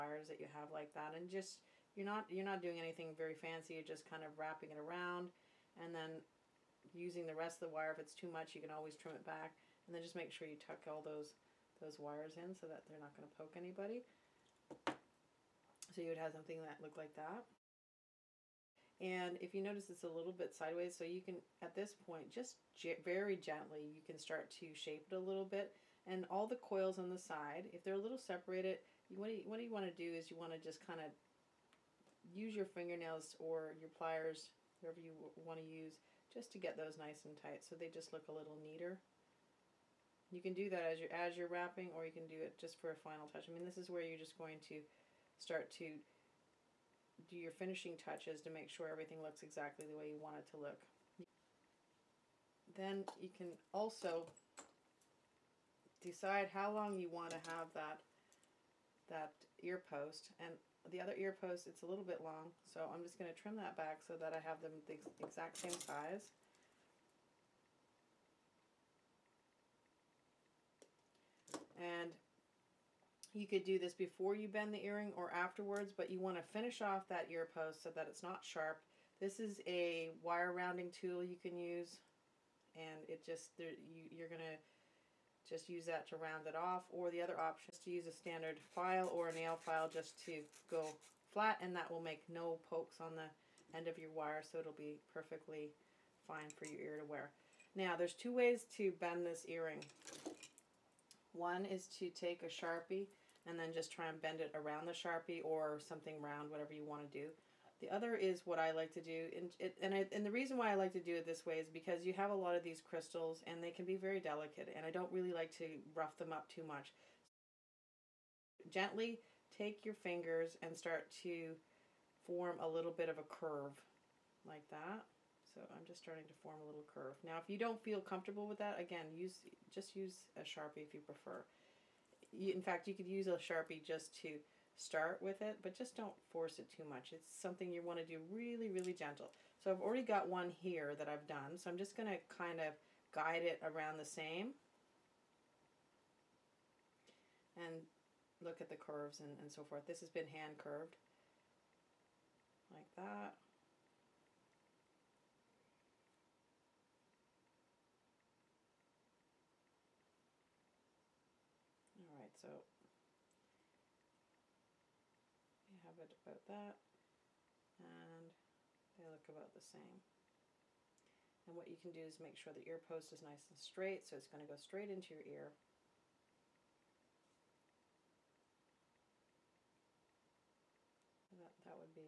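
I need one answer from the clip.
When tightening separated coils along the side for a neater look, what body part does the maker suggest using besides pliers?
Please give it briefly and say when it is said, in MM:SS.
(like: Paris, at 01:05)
fingernails, at 00:32.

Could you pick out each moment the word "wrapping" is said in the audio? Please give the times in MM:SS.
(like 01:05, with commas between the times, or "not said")
00:04, 00:41.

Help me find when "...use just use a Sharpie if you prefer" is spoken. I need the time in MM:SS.
02:09.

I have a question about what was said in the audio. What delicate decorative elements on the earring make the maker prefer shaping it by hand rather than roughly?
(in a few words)
crystals.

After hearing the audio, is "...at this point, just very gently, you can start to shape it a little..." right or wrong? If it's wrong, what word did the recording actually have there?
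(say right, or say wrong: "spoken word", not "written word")
right.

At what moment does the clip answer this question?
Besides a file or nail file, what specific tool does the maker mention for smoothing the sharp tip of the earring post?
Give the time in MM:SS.
01:20.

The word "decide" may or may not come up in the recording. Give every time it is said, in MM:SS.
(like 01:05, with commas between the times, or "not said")
00:55.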